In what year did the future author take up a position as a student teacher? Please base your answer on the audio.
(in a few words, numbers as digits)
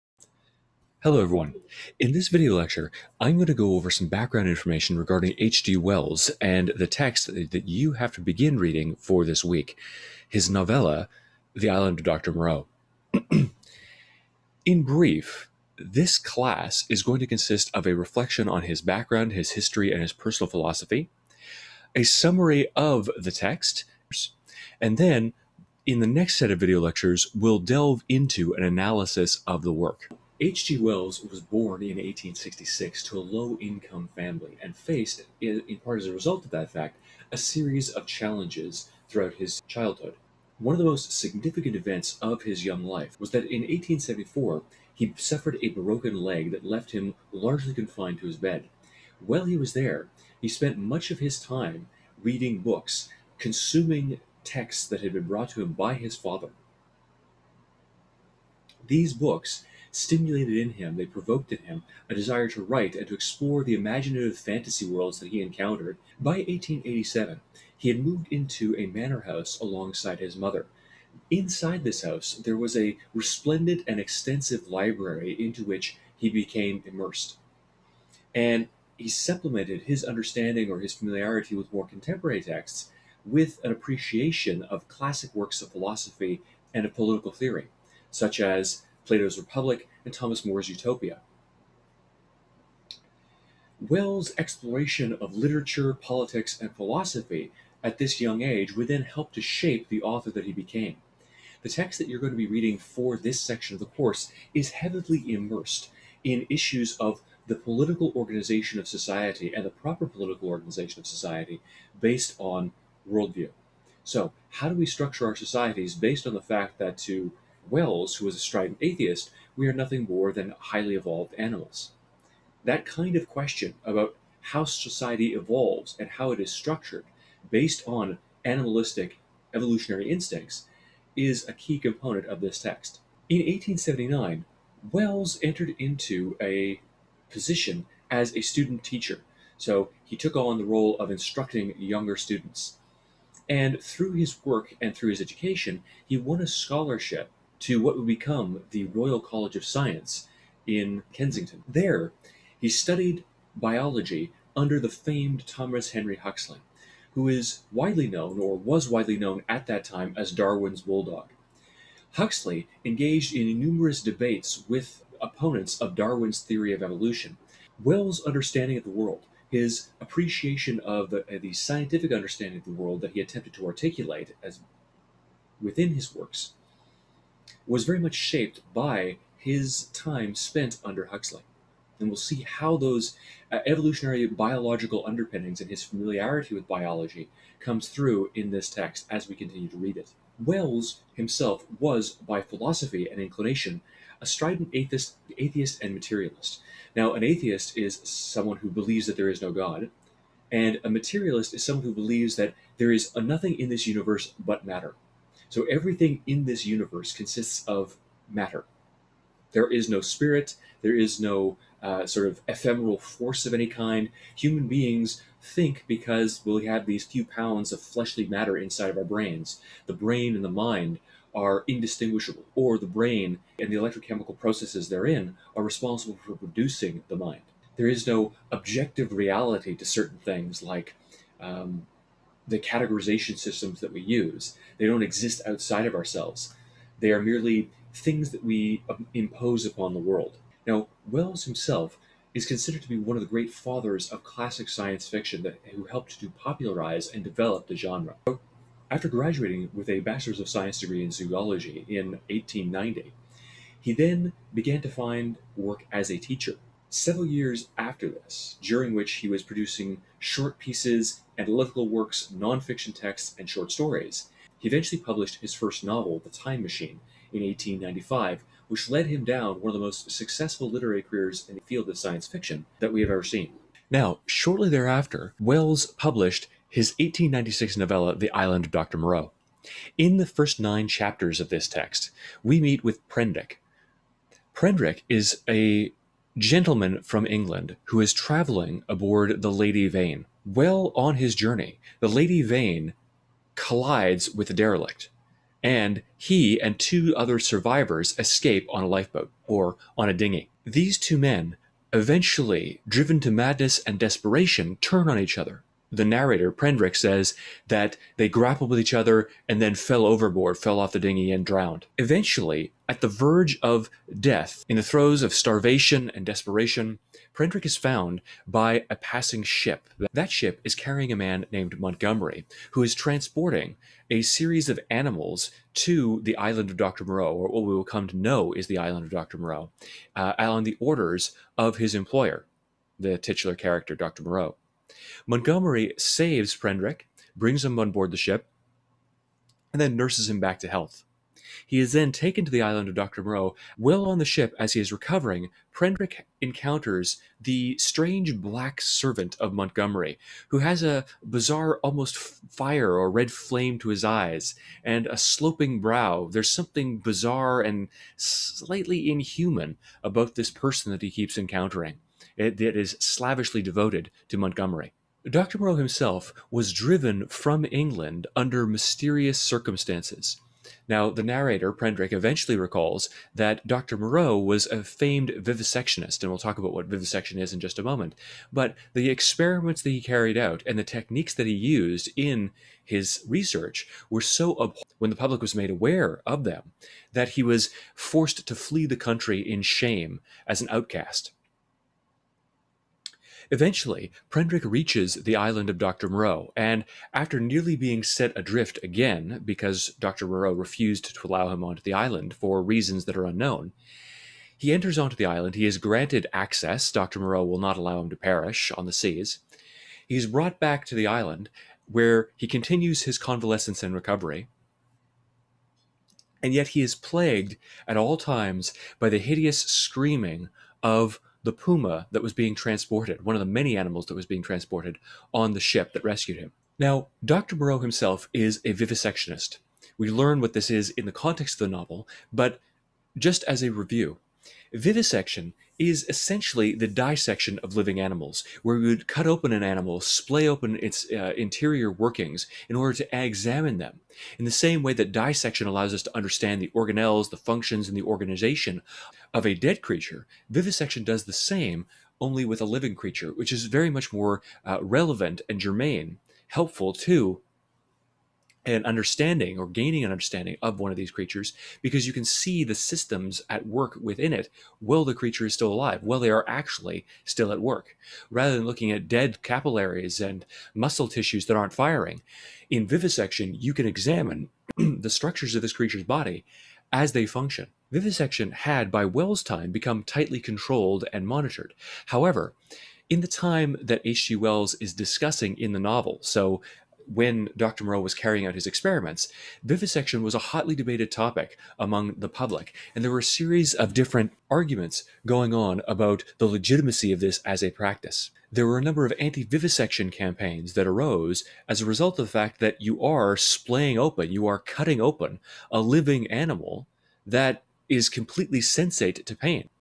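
1879.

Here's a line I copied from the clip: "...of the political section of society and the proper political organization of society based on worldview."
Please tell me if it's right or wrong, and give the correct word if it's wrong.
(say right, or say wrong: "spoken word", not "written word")
wrong: "organization", not "section".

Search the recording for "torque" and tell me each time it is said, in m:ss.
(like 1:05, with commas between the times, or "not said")
not said.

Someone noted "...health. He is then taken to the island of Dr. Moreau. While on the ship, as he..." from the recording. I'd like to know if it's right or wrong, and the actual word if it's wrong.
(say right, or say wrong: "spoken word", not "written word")
right.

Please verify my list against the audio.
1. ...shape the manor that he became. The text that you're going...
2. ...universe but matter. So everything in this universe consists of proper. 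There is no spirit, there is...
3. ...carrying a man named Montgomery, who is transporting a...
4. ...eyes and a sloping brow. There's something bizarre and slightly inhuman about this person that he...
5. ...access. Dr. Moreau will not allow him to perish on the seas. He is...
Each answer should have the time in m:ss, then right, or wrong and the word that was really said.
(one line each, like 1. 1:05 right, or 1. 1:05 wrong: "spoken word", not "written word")
1. 1:39 wrong: "author", not "manor"
2. 3:23 wrong: "matter", not "proper"
3. 5:20 right
4. 5:54 right
5. 6:46 right.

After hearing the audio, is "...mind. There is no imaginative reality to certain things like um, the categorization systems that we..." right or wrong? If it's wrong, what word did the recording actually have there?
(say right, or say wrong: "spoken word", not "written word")
wrong: "objective", not "imaginative".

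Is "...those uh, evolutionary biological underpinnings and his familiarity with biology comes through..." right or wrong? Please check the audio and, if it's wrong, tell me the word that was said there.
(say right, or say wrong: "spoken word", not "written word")
right.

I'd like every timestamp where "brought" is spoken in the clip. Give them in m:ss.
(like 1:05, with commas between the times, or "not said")
0:55, 6:50.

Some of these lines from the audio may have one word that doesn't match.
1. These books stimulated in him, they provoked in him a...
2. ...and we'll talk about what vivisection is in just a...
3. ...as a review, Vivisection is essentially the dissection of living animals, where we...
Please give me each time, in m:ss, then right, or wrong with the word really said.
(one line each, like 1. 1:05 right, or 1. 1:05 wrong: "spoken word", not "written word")
1. 0:58 right
2. 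6:16 right
3. 7:13 right.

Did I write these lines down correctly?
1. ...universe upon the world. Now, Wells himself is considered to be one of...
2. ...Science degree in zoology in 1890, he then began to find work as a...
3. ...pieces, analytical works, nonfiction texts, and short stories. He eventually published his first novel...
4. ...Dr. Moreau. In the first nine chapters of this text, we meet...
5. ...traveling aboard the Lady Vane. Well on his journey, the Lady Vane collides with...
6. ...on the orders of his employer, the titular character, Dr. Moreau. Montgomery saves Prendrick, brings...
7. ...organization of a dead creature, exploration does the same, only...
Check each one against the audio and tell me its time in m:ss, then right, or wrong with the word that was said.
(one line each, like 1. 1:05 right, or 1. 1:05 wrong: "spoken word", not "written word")
1. 3:59 wrong: "impose", not "universe"
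2. 4:10 right
3. 4:20 right
4. 4:38 right
5. 4:48 right
6. 5:30 right
7. 7:28 wrong: "vivisection", not "exploration".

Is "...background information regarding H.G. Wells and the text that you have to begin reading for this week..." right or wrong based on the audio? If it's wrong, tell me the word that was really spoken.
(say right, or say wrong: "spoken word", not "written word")
right.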